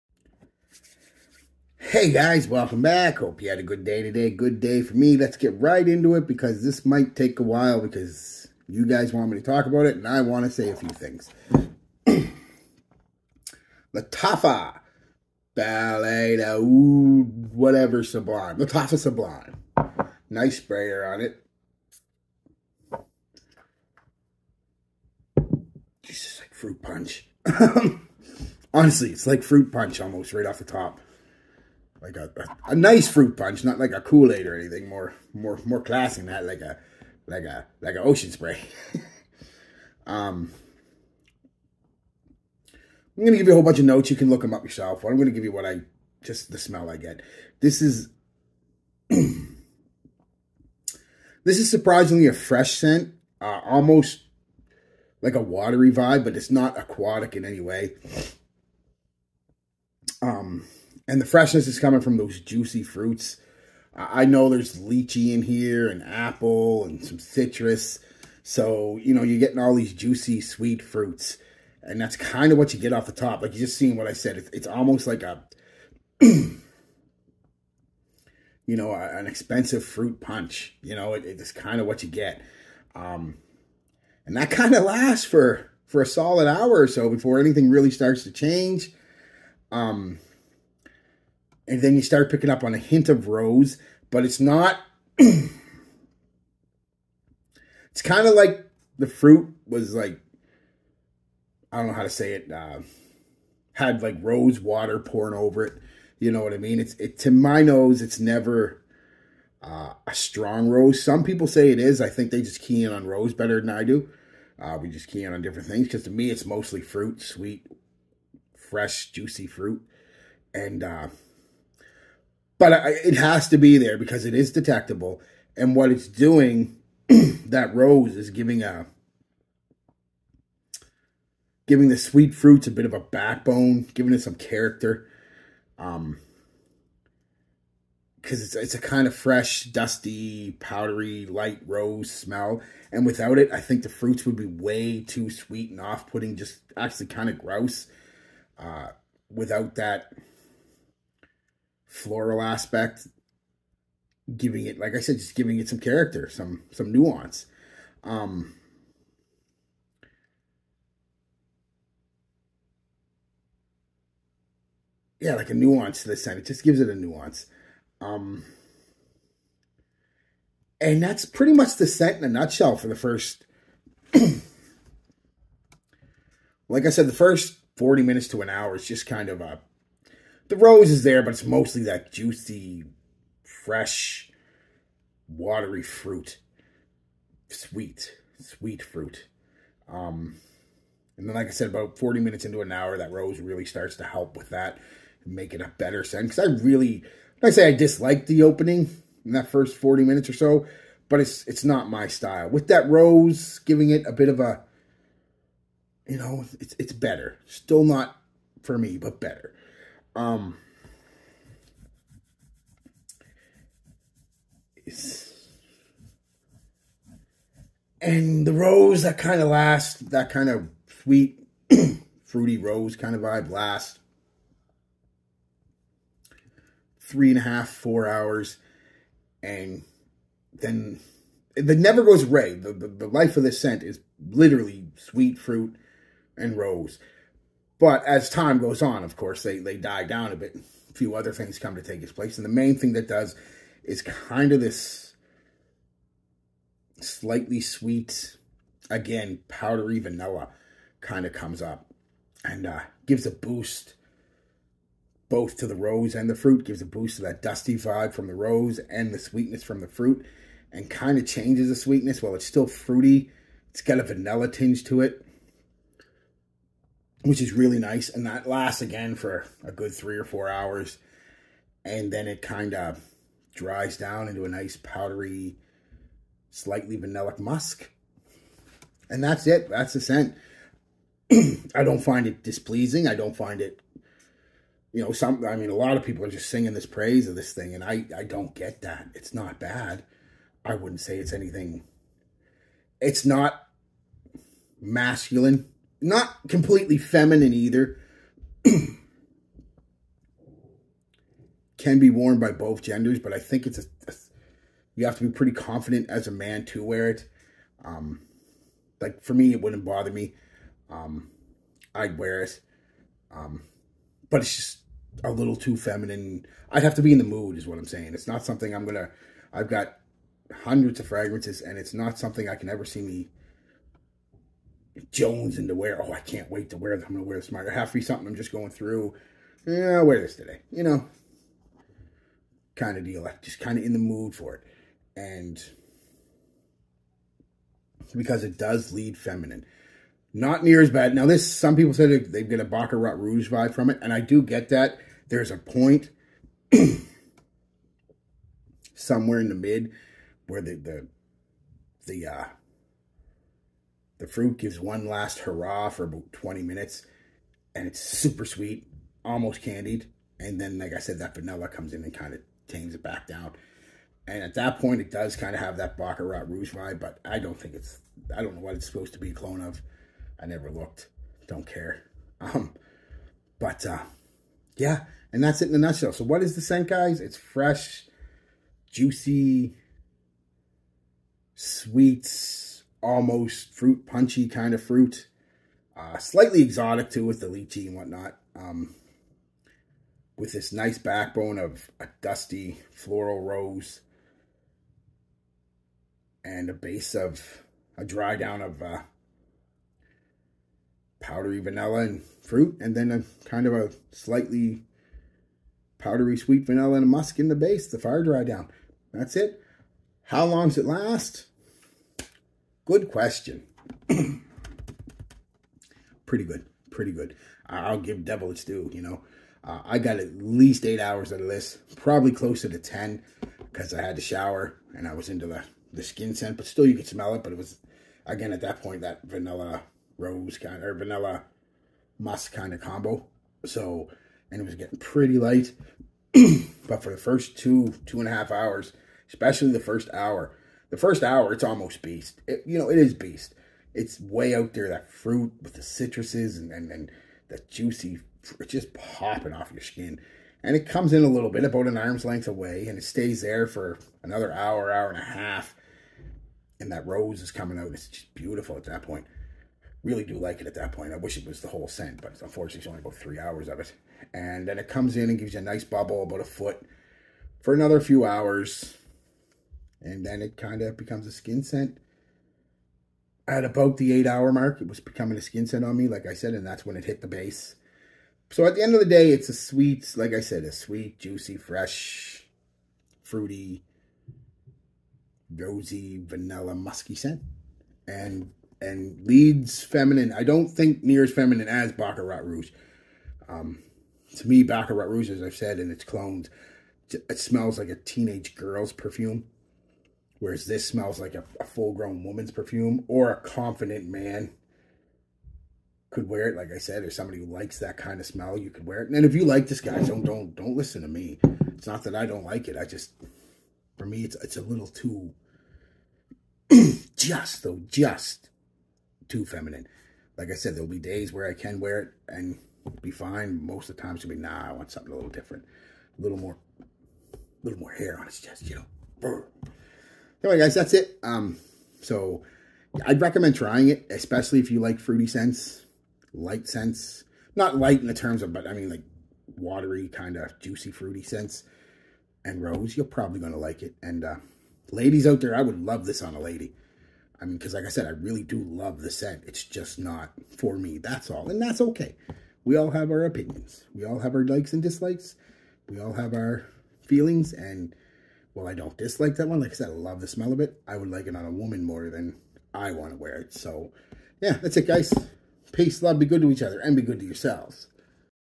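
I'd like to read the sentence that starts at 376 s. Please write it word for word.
So what is the scent, guys?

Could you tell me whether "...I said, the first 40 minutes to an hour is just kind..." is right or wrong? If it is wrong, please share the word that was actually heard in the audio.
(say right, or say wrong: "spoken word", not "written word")
right.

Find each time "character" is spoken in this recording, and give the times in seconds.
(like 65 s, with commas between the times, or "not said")
134 s, 155 s.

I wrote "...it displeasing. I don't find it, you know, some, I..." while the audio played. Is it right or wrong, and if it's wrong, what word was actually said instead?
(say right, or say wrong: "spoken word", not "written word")
right.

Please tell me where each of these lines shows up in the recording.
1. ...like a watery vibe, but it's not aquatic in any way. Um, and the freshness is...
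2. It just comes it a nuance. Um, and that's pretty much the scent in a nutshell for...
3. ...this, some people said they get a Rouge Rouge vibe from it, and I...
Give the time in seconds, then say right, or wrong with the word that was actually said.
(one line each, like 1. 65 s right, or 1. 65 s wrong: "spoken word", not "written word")
1. 55 s right
2. 166 s wrong: "gives", not "comes"
3. 341 s wrong: "Baccarat", not "Rouge".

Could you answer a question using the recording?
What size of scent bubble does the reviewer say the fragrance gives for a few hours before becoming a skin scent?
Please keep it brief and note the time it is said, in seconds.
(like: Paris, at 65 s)
About a foot, at 466 s.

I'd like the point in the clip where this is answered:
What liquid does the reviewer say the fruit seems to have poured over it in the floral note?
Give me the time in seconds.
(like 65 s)
104 s.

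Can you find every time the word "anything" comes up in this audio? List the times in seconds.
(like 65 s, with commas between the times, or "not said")
34 s, 87 s, 291 s.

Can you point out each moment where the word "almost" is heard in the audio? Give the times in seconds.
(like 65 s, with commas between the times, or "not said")
29 s, 53 s, 74 s, 359 s, 383 s, 441 s.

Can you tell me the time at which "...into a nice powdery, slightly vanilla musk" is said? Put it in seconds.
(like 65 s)
274 s.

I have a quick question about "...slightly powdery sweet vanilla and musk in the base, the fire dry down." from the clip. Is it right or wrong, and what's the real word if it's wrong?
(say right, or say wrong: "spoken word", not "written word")
right.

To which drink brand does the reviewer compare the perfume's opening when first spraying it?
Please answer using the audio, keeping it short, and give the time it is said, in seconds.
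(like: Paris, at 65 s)
Ocean Spray, at 38 s.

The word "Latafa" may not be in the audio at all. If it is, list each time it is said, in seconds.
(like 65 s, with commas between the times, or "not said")
13 s, 18 s.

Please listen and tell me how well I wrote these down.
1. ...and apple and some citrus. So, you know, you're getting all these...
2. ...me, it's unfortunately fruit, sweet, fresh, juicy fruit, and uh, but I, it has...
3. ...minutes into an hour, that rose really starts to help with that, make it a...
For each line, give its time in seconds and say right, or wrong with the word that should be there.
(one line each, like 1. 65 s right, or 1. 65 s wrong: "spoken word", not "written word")
1. 65 s right
2. 116 s wrong: "mostly", not "unfortunately"
3. 192 s right.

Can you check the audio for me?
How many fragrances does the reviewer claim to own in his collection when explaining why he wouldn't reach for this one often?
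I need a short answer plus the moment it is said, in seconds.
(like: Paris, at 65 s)
Hundreds, at 320 s.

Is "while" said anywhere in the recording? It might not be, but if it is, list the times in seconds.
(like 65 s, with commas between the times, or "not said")
7 s, 262 s.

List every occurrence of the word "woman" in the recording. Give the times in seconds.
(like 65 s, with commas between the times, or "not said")
502 s, 561 s.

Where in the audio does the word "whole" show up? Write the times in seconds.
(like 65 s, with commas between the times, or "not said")
43 s, 461 s.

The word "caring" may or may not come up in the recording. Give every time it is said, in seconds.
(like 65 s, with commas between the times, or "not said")
not said.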